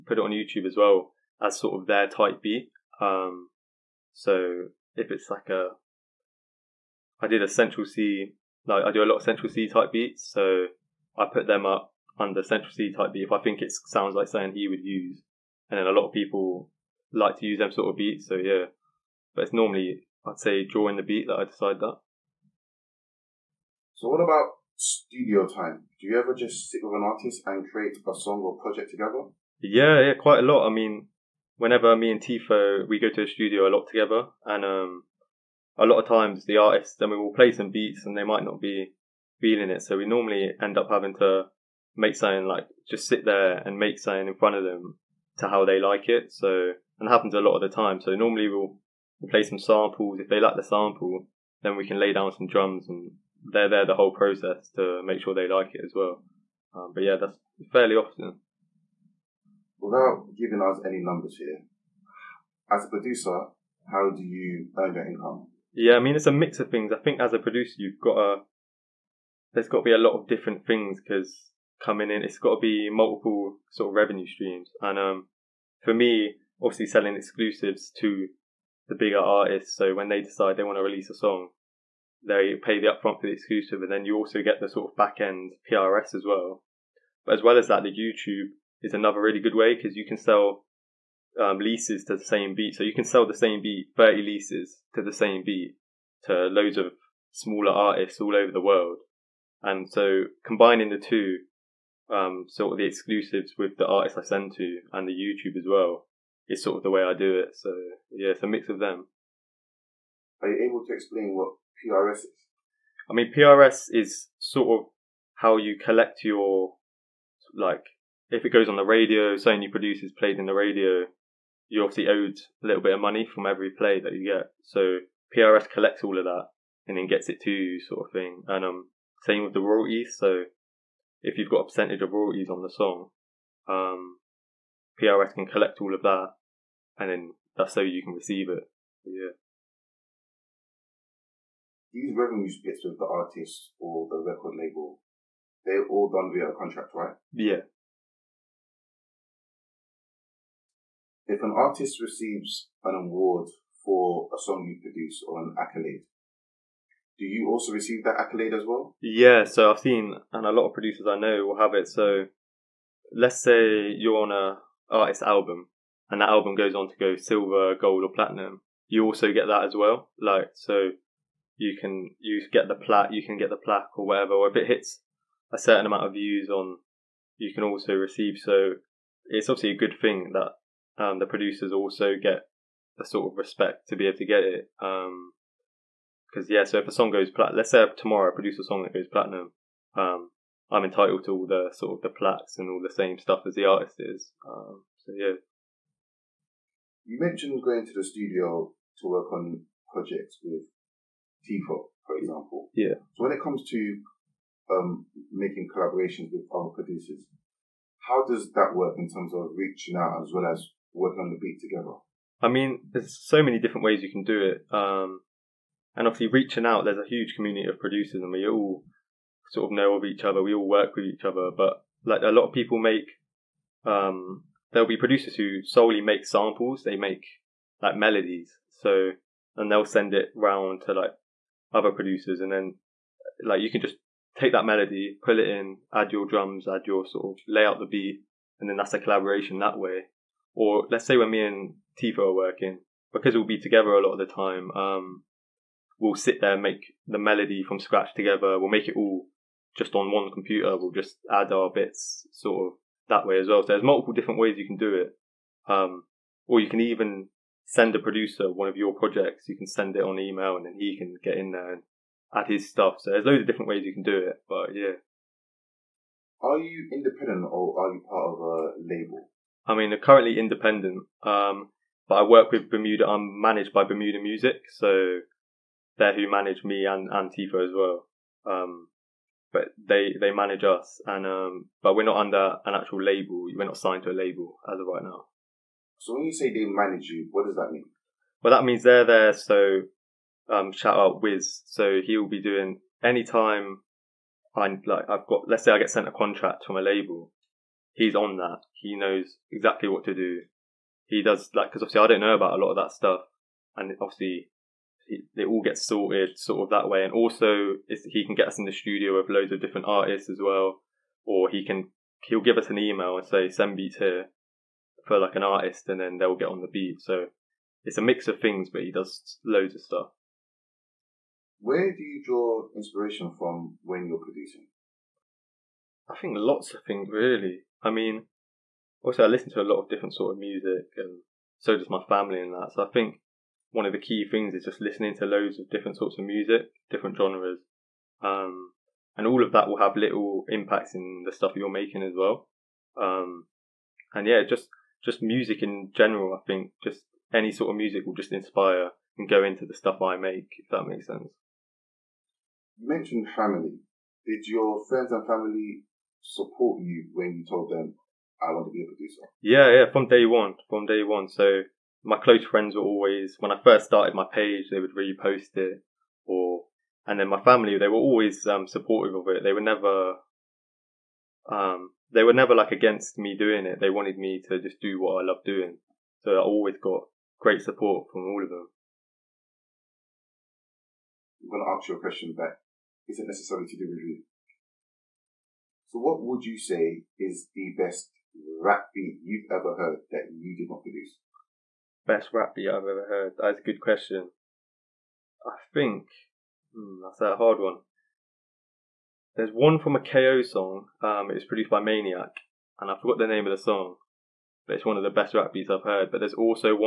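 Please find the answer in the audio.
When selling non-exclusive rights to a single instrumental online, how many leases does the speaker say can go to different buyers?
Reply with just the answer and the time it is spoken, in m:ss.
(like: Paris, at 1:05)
30, at 1:33.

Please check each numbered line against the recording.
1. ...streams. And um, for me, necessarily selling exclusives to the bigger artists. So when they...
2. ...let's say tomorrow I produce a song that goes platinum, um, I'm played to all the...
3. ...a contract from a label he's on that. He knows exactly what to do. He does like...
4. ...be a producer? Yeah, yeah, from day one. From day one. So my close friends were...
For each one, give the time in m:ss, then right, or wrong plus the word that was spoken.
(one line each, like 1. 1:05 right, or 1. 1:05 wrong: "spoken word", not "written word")
1. 1:14 wrong: "obviously", not "necessarily"
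2. 3:07 wrong: "entitled", not "played"
3. 4:56 right
4. 5:58 right.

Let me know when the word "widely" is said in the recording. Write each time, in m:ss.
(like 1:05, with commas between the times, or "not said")
not said.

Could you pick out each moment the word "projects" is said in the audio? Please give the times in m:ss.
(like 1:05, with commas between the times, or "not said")
0:28, 3:19, 4:18.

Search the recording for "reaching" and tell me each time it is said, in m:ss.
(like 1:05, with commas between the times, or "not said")
3:29, 3:36.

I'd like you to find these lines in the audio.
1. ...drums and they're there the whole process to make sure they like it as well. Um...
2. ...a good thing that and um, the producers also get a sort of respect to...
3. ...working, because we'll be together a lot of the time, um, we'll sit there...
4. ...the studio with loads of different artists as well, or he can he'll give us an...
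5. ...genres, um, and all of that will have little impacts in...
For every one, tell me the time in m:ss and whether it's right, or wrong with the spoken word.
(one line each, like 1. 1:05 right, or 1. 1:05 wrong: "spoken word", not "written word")
1. 0:52 right
2. 2:59 right
3. 4:02 right
4. 5:08 right
5. 5:37 right.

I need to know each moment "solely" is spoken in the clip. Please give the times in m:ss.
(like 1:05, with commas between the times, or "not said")
3:45.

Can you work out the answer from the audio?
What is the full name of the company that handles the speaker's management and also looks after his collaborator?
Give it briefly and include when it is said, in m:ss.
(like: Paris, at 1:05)
Bermuda Music, at 4:33.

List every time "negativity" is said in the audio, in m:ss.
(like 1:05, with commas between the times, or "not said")
not said.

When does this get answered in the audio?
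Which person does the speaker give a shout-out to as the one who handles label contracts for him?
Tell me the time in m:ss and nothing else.
4:51.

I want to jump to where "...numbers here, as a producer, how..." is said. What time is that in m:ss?
1:01.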